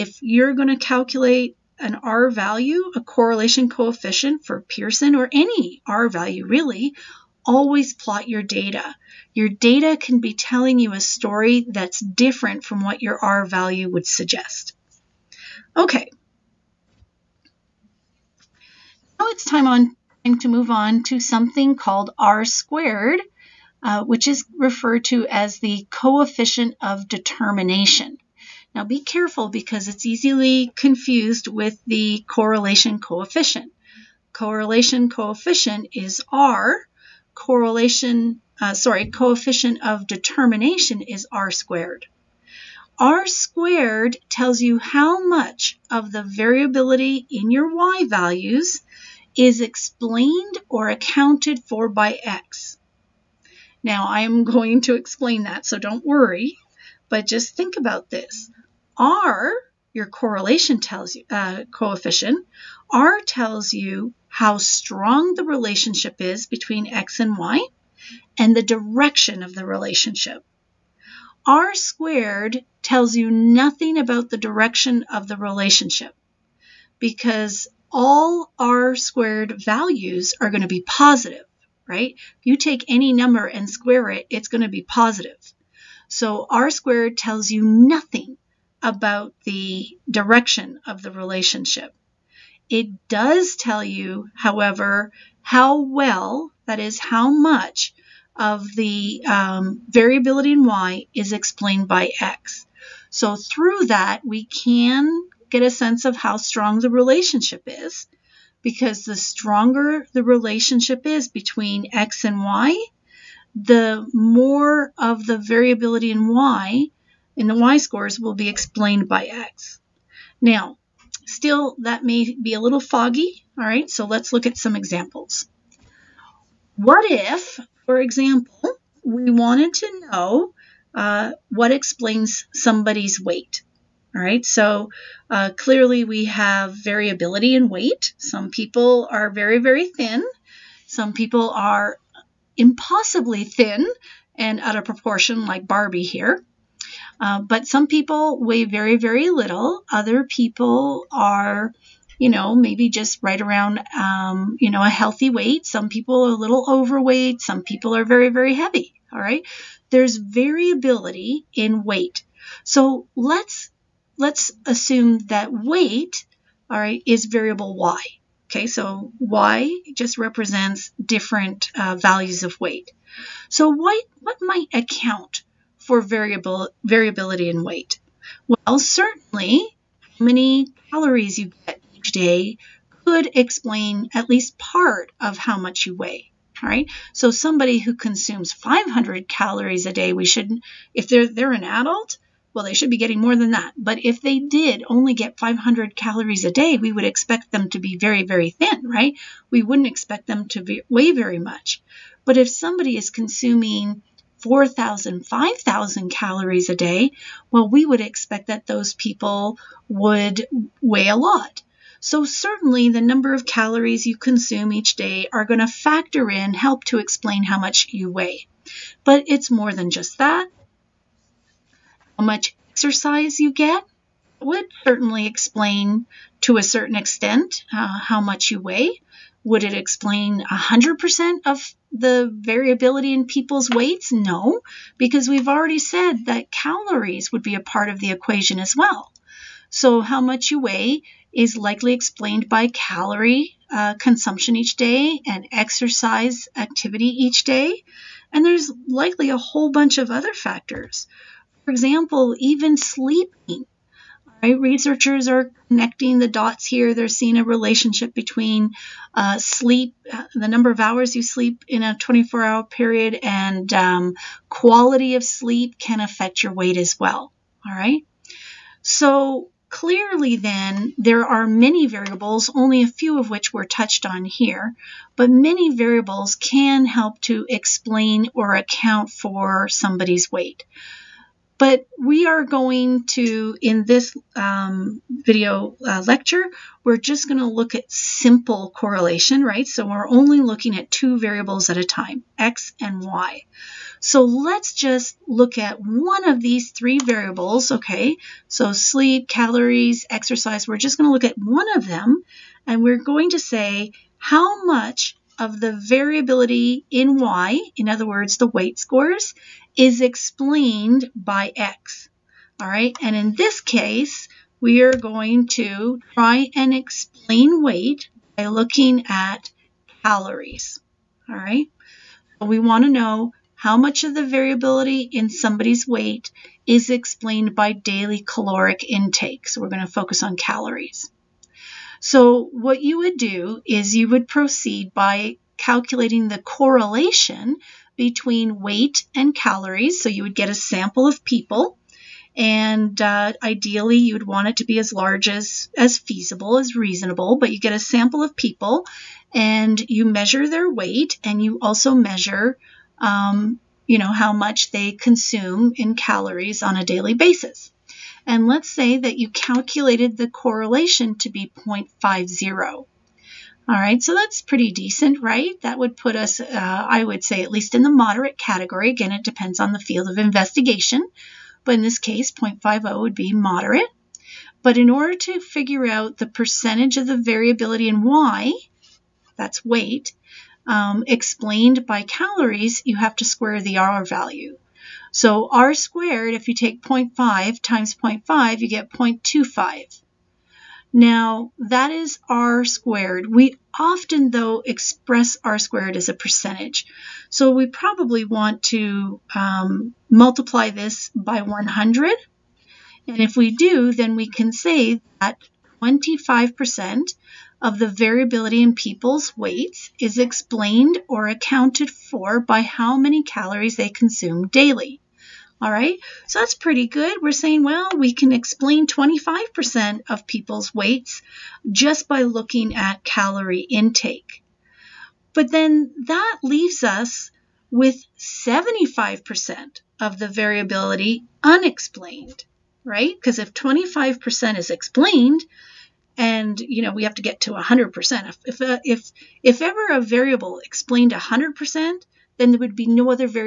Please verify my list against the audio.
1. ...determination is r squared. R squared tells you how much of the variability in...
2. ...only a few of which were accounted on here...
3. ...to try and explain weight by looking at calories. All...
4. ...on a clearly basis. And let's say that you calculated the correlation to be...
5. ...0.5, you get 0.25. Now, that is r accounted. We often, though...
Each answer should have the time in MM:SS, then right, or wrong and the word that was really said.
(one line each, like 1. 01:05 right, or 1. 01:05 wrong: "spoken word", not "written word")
1. 00:40 right
2. 04:32 wrong: "touched", not "accounted"
3. 05:15 right
4. 05:56 wrong: "daily", not "clearly"
5. 06:27 wrong: "squared", not "accounted".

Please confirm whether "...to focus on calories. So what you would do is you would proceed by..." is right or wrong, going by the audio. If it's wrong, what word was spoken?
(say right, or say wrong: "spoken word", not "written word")
right.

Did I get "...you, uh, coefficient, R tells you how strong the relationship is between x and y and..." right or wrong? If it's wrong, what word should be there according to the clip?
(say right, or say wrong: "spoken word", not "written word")
right.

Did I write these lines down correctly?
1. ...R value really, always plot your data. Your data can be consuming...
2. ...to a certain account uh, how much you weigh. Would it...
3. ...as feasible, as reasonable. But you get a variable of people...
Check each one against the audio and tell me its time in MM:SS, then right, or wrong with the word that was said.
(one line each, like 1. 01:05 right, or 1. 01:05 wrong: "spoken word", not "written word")
1. 00:05 wrong: "telling", not "consuming"
2. 03:46 wrong: "extent", not "account"
3. 05:45 wrong: "sample", not "variable".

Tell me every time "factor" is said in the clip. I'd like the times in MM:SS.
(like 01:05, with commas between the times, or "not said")
03:35, 04:10.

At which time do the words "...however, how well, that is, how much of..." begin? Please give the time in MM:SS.
01:34.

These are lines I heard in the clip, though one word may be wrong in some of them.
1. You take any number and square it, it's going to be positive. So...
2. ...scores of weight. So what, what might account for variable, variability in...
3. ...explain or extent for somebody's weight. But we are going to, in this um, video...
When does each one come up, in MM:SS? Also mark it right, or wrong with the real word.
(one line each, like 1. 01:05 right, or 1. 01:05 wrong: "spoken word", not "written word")
1. 01:22 right
2. 02:51 wrong: "values", not "scores"
3. 04:37 wrong: "account", not "extent".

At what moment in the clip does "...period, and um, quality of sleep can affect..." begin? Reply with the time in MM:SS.
04:22.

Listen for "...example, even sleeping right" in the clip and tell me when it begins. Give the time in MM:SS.
04:11.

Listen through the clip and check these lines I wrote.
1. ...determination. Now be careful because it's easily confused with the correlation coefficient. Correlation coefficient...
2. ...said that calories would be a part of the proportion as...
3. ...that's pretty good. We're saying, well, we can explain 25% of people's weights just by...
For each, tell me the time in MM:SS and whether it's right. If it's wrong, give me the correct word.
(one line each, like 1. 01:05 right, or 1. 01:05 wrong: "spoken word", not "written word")
1. 00:27 right
2. 03:55 wrong: "equation", not "proportion"
3. 06:56 right.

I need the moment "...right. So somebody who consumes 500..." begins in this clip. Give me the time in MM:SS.
03:06.